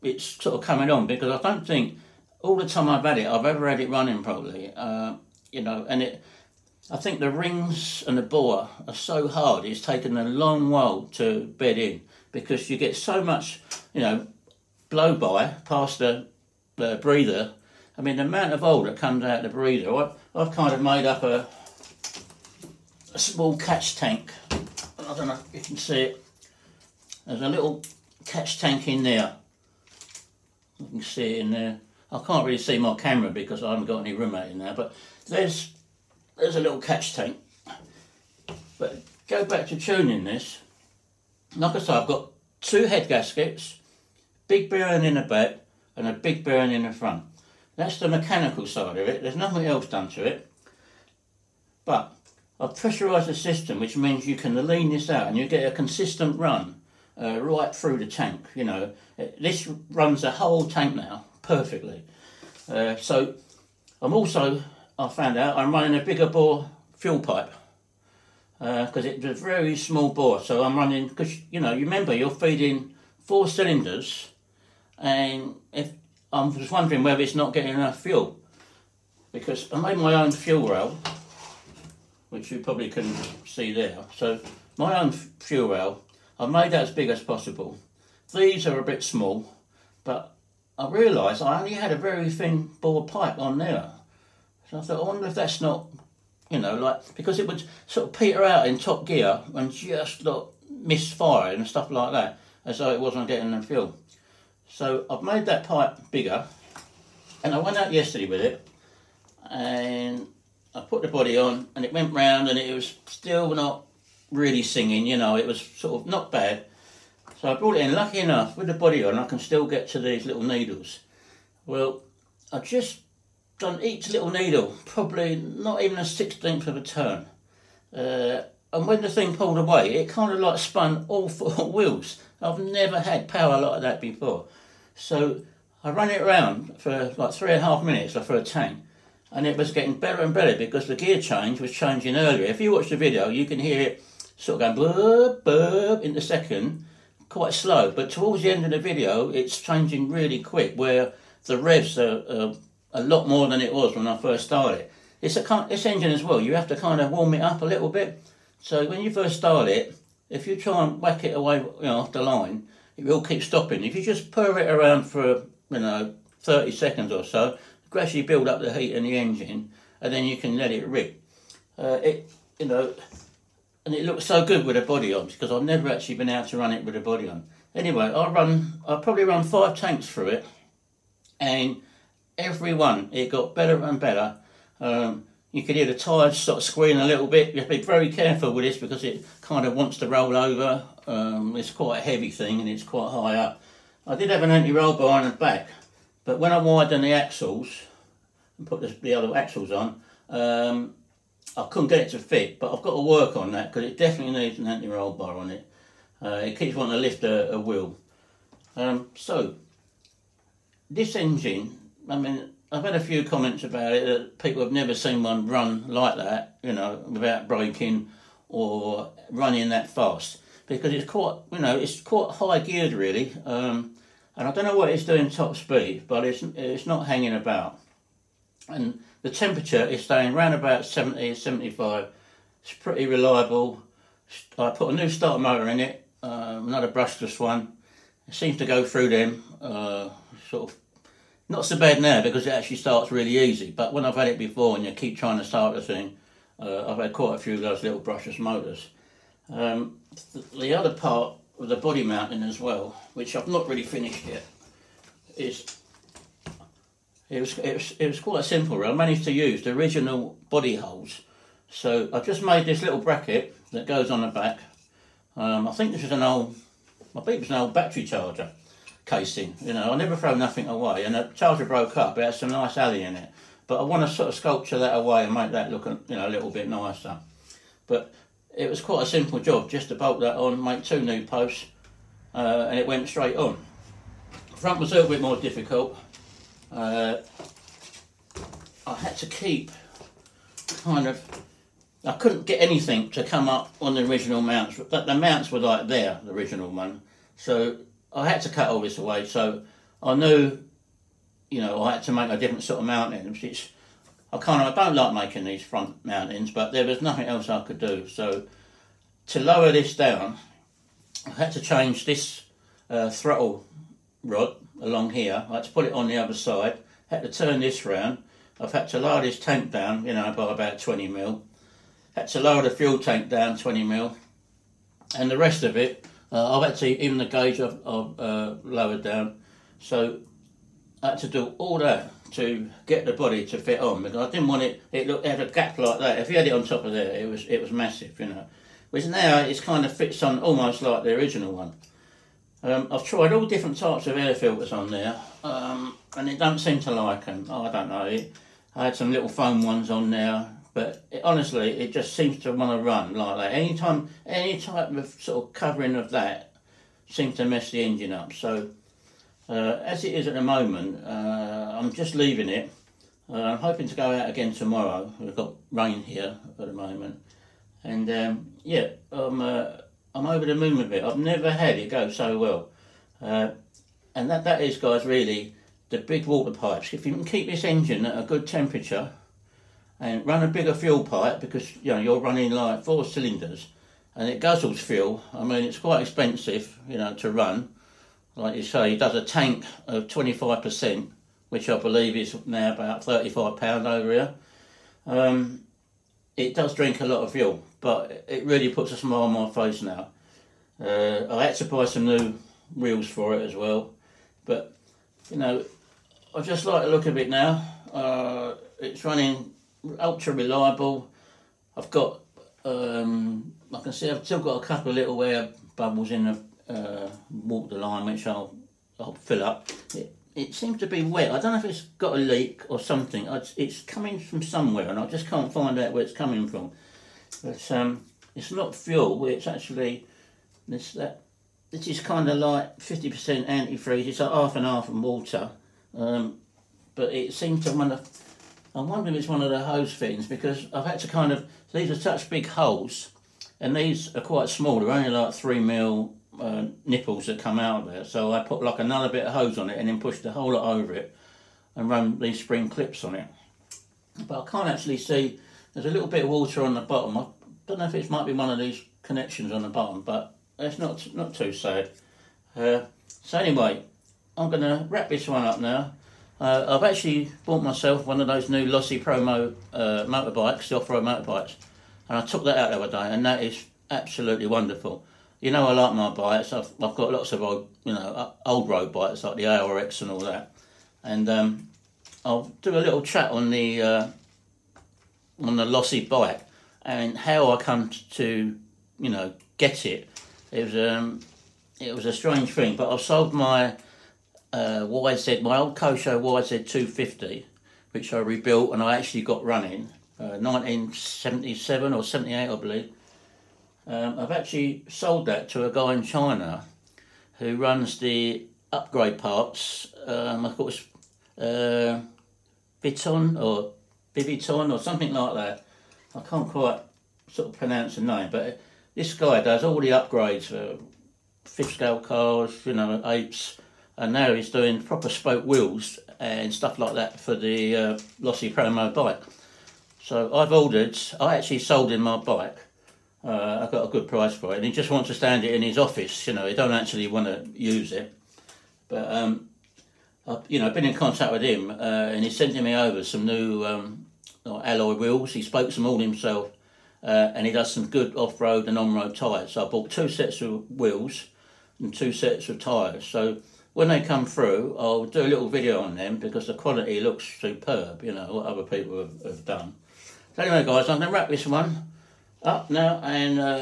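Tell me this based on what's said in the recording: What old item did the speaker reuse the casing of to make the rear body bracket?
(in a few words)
Battery charger.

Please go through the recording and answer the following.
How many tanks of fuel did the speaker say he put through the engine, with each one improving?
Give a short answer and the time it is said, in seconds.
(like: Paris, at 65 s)
5, at 179 s.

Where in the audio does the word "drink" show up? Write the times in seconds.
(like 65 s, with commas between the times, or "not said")
396 s.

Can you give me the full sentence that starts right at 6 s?
I think the rings and the bore are so hard.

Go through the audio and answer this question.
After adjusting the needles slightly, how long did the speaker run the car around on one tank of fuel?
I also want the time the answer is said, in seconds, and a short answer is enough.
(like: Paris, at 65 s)
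3.5 minutes, at 137 s.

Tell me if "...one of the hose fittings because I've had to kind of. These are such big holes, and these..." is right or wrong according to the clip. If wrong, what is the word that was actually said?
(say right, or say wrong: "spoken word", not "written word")
right.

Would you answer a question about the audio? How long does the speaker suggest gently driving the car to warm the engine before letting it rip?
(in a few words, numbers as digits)
30 seconds.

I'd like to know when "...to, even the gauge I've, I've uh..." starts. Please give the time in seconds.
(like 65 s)
326 s.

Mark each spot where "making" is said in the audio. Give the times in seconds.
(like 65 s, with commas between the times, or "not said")
305 s.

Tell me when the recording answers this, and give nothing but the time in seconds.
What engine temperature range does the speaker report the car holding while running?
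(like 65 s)
230 s.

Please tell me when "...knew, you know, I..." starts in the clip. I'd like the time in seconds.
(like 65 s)
300 s.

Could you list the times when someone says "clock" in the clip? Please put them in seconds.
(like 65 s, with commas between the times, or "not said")
not said.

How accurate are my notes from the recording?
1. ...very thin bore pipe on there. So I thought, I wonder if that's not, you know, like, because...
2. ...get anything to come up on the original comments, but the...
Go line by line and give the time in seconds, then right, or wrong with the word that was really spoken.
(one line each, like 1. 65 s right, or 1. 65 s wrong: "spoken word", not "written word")
1. 91 s right
2. 292 s wrong: "mounts", not "comments".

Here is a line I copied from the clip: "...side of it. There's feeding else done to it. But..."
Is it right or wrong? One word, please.
wrong.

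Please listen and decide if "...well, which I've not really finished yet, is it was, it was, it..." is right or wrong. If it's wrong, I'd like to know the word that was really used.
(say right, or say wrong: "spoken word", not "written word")
right.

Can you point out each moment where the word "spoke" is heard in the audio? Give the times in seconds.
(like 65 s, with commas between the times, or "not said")
525 s, 545 s.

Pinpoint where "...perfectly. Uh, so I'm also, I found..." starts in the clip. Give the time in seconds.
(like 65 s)
61 s.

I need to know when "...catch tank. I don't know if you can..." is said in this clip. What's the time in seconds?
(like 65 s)
23 s.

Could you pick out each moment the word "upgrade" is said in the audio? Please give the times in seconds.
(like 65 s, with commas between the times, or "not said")
508 s, 519 s.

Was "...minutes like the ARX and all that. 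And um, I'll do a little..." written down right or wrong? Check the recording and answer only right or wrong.
wrong.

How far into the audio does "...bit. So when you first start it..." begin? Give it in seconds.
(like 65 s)
157 s.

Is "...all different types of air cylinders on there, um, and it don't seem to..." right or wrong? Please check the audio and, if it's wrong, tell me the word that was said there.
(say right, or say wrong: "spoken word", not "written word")
wrong: "filters", not "cylinders".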